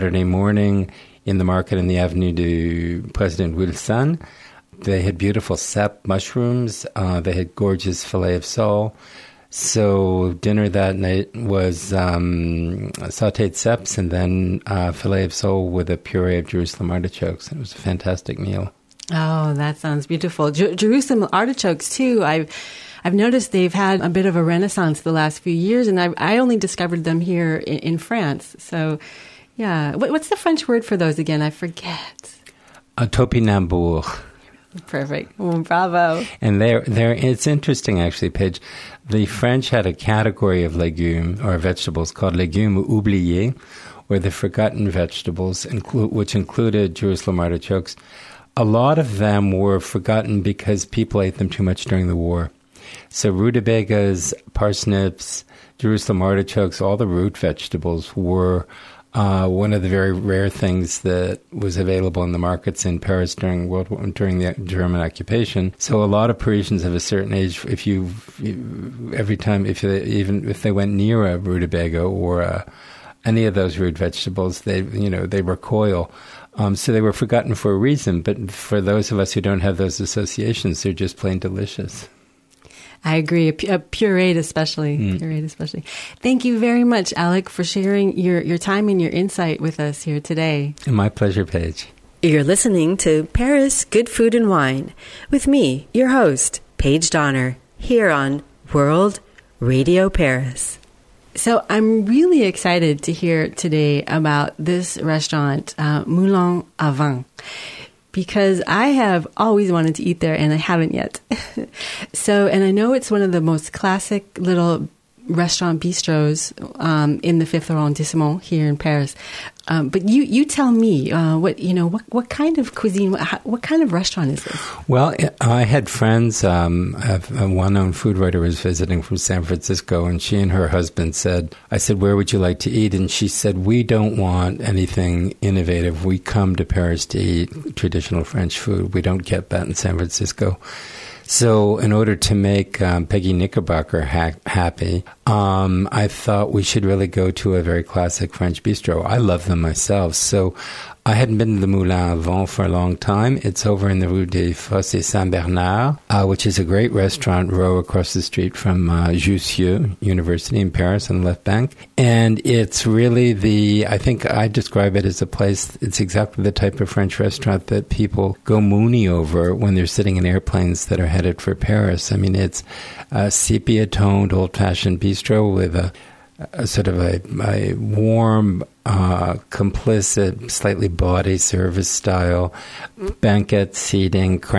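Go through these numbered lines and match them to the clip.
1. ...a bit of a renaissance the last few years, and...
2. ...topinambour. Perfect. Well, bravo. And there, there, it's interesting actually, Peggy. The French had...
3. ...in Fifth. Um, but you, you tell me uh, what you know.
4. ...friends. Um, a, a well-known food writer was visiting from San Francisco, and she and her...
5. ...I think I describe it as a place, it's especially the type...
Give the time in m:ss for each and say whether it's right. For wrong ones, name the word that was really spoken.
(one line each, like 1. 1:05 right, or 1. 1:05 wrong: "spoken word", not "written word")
1. 0:23 right
2. 0:33 wrong: "Paige", not "Peggy"
3. 1:58 wrong: "Paris", not "Fifth"
4. 2:05 right
5. 2:43 wrong: "exactly", not "especially".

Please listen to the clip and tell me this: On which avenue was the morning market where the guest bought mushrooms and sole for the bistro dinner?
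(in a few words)
Avenue du President Wilson.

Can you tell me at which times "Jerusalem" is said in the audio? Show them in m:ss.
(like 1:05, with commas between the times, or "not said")
0:16, 0:20, 0:46, 0:55.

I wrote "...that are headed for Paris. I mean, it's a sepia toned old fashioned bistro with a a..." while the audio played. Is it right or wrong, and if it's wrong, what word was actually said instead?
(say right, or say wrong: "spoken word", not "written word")
right.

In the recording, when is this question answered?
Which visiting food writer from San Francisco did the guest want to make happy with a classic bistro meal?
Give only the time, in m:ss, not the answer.
2:23.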